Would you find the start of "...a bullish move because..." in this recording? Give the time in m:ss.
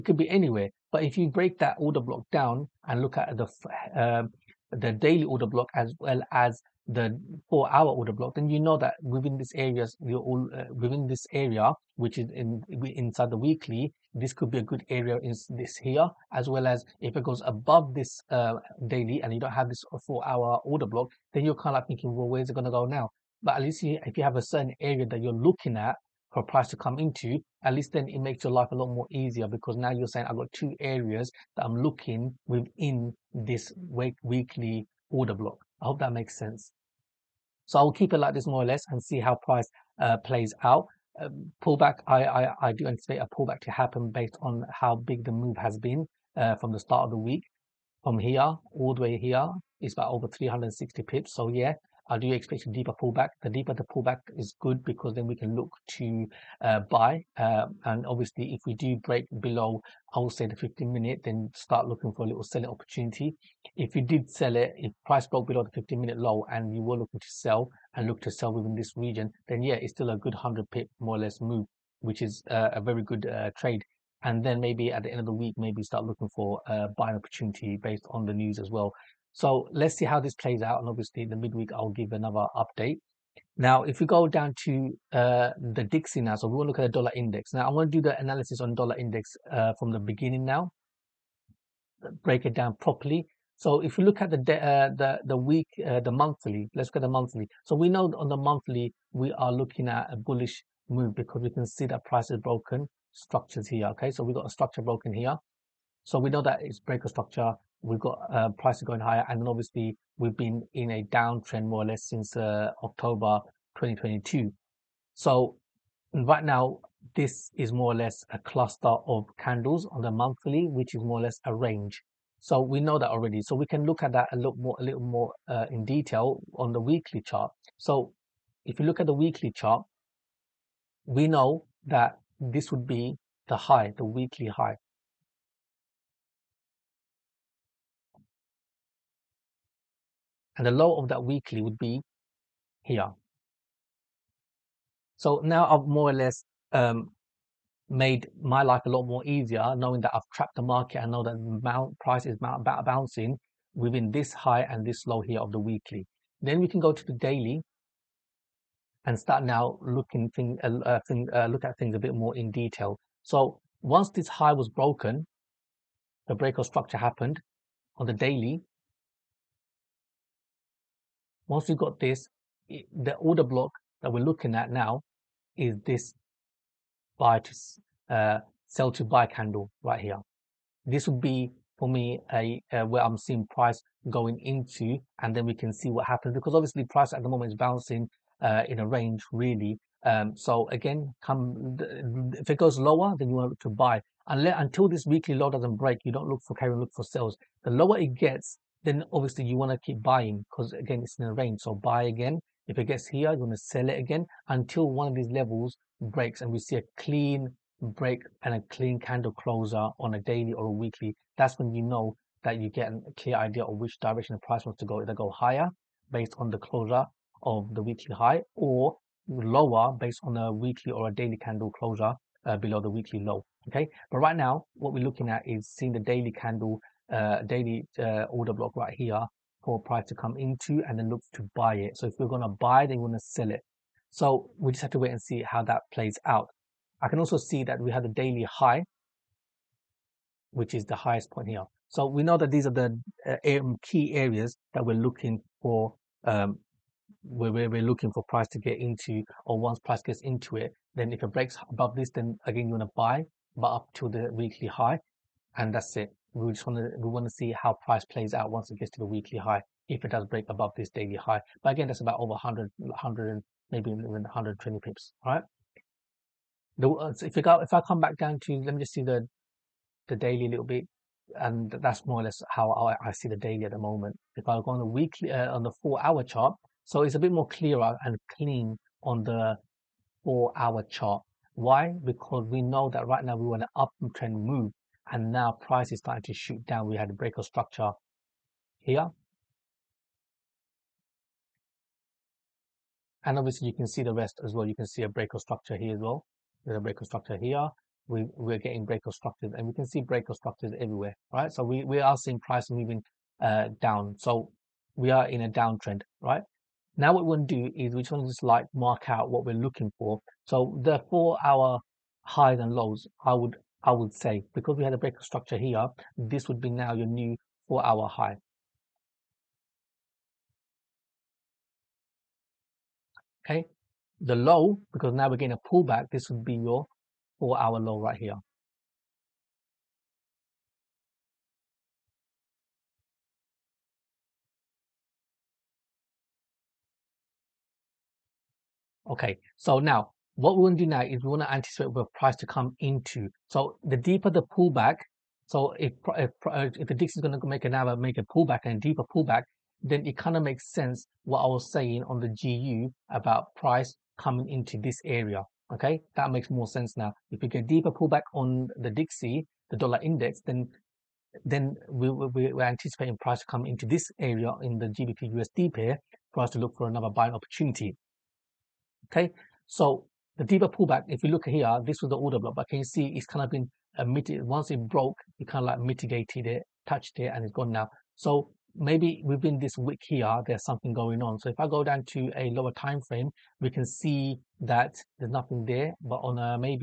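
1:40.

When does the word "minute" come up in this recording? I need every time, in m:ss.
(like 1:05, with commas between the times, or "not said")
1:00, 1:05.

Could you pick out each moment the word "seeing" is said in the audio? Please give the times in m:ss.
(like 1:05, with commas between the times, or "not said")
3:03, 3:45, 5:02.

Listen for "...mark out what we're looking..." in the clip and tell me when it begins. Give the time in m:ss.
5:08.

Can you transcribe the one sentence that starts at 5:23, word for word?
Okay, the low, because now we're getting a pullback, this would be your four hour low right here.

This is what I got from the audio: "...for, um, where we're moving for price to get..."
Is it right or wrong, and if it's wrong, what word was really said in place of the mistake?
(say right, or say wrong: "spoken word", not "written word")
wrong: "looking", not "moving".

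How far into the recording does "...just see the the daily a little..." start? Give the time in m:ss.
4:28.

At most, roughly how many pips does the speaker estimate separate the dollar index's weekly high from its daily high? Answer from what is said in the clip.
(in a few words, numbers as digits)
120 pips.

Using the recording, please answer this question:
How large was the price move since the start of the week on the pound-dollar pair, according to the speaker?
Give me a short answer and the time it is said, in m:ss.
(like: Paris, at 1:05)
over 360 pips, at 0:50.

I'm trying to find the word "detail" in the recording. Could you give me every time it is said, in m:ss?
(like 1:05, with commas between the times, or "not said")
2:05, 2:42.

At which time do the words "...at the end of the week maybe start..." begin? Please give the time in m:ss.
1:14.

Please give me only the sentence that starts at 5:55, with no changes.
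Okay, that makes more sense now.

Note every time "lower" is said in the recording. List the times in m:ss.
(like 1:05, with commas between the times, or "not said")
3:12, 3:17, 3:39, 6:22.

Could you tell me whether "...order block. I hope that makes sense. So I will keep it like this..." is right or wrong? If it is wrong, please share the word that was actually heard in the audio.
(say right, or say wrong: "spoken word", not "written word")
right.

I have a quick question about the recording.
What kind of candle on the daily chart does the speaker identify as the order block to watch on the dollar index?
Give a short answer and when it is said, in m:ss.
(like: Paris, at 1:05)
sell to buy candle, at 2:58.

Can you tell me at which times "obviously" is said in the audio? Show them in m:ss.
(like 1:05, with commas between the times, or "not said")
0:58, 1:20, 1:49, 3:06, 3:19, 4:53.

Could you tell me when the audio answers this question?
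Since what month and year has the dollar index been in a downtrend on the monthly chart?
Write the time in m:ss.
1:52.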